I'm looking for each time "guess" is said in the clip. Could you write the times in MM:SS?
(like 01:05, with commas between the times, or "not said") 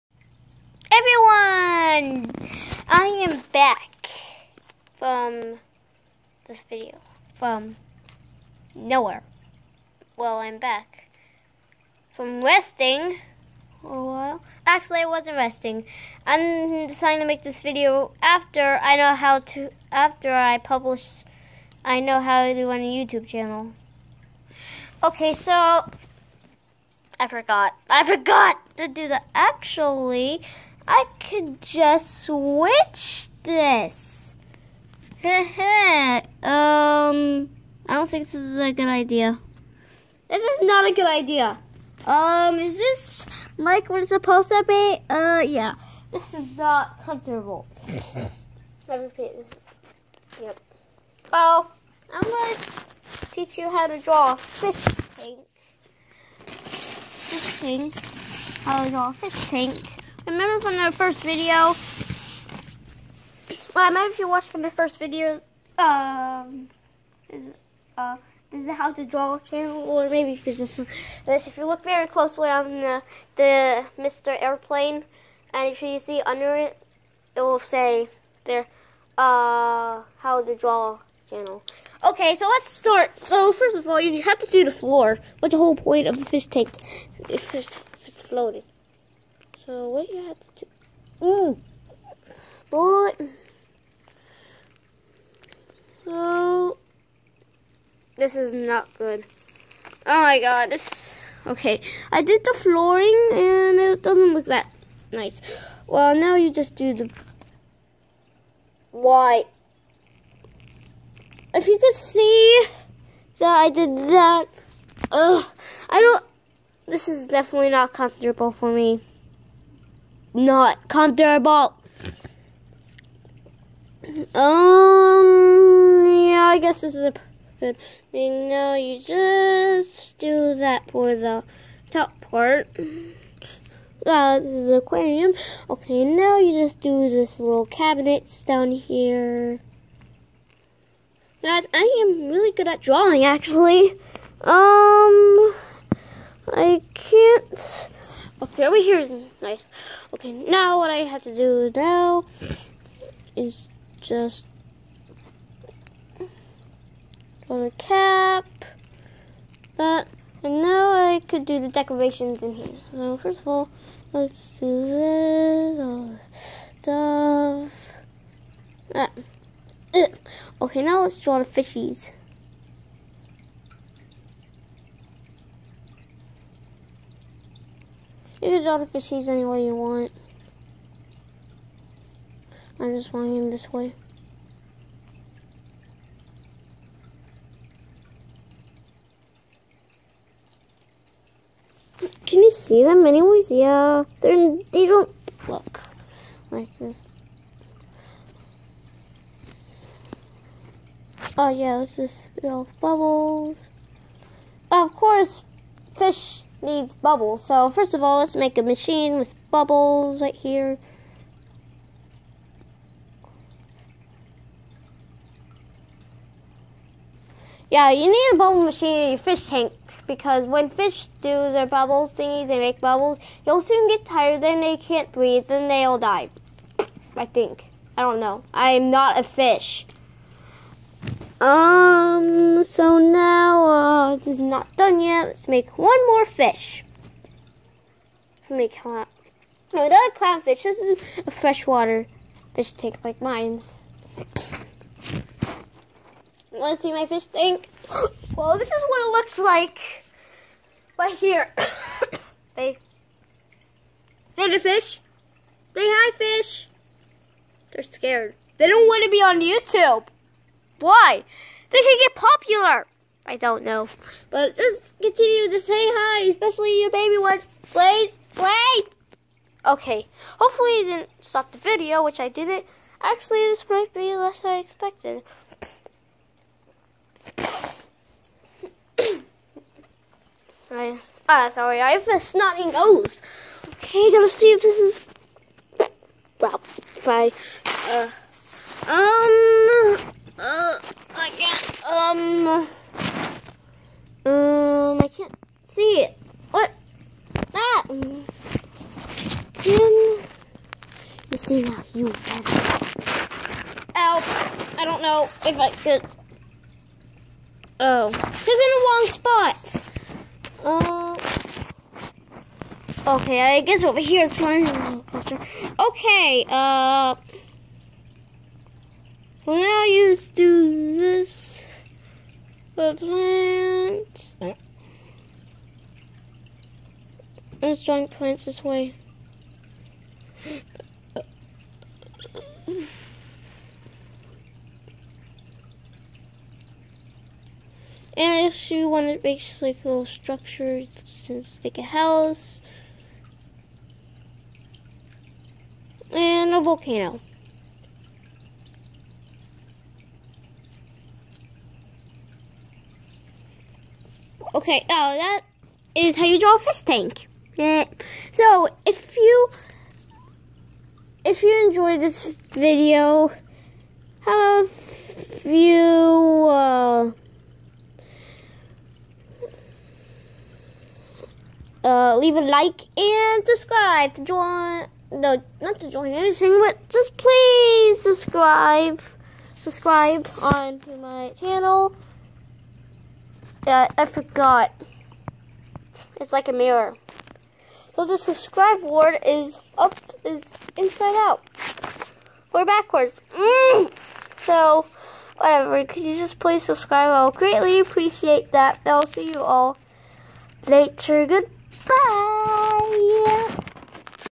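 02:06, 05:13.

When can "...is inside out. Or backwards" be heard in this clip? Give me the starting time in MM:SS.
06:30.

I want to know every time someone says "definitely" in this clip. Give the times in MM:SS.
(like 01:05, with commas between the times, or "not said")
01:57.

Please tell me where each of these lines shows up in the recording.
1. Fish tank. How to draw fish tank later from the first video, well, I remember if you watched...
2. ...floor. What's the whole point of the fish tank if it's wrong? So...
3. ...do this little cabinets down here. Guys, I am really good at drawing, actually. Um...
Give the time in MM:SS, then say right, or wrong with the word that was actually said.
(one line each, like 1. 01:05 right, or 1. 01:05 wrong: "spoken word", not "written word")
1. 00:56 wrong: "remember", not "later"
2. 01:24 wrong: "floating", not "wrong"
3. 02:16 right.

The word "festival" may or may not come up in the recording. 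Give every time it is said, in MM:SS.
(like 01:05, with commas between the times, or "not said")
not said.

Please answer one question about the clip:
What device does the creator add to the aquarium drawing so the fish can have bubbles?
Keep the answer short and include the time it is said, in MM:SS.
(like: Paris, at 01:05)
A bubble machine, at 03:38.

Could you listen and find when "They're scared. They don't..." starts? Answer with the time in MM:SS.
04:17.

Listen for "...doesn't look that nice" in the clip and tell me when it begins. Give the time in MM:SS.
01:44.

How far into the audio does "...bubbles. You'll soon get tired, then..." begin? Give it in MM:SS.
03:42.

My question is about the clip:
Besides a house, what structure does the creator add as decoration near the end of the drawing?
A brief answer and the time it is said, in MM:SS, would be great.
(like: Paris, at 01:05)
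A volcano, at 05:46.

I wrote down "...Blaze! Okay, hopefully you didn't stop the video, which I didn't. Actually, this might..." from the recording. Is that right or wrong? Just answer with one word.
right.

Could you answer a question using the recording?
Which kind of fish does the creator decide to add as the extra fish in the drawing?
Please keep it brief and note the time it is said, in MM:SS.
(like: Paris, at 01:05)
A clownfish, at 04:00.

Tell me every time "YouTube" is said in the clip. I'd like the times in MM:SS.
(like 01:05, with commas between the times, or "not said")
00:23, 04:19.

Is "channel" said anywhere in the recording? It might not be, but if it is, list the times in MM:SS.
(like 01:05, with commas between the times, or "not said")
00:23, 01:09, 01:21, 06:21.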